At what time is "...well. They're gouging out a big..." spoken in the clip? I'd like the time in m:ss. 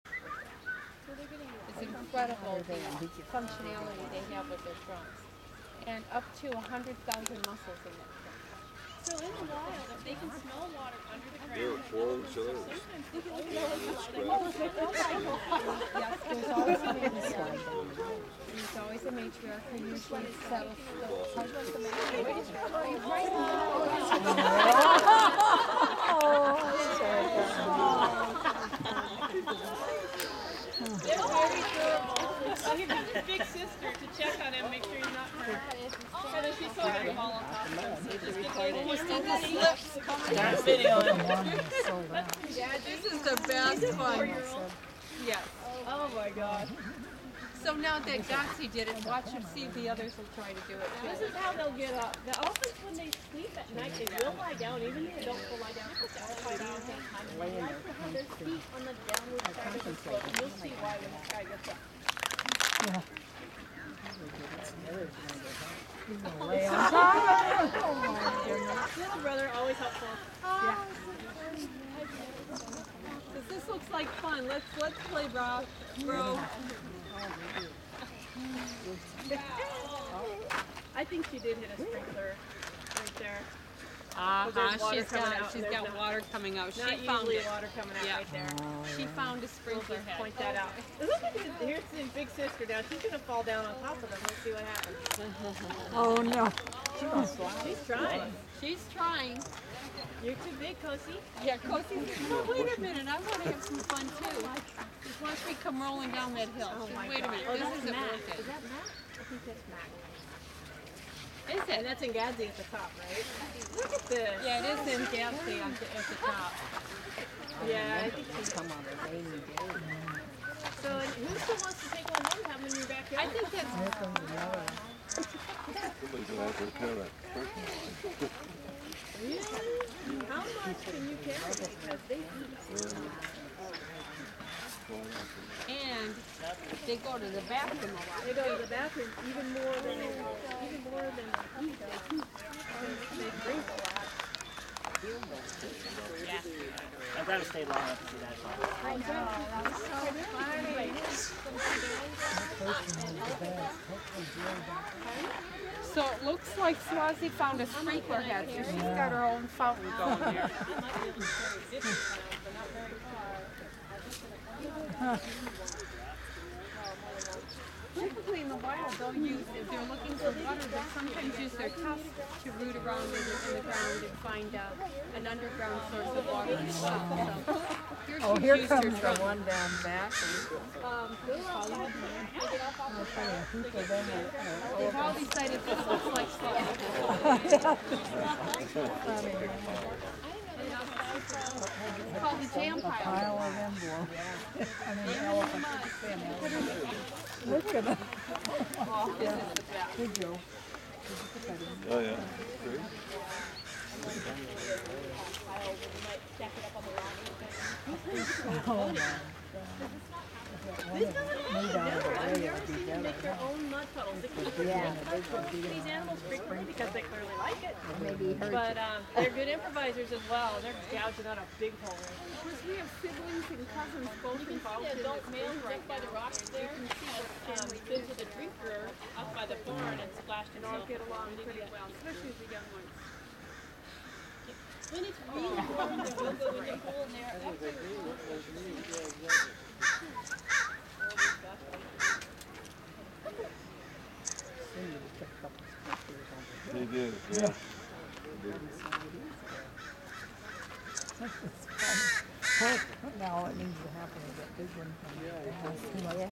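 3:40.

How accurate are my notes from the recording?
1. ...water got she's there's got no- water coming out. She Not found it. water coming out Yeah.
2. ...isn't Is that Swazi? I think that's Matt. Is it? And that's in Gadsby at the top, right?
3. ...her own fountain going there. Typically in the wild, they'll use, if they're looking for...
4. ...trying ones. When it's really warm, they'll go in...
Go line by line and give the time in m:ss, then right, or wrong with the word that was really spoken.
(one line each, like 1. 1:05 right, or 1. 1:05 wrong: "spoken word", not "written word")
1. 1:24 right
2. 1:47 wrong: "Mac", not "Swazi"
3. 2:39 right
4. 3:52 wrong: "young", not "trying".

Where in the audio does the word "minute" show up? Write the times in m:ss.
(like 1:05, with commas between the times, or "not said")
1:42, 1:47.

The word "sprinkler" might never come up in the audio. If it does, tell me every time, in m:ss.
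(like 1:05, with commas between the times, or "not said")
1:21, 1:29, 2:37.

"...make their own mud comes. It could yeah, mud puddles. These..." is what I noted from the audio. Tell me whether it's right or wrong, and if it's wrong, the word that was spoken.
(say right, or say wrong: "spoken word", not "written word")
wrong: "puddles", not "comes".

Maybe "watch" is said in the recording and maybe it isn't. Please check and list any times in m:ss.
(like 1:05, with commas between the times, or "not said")
0:49, 1:45.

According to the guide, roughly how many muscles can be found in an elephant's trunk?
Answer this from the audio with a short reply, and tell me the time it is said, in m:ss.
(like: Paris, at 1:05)
100,000, at 0:06.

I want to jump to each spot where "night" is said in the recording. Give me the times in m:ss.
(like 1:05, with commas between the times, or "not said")
0:53.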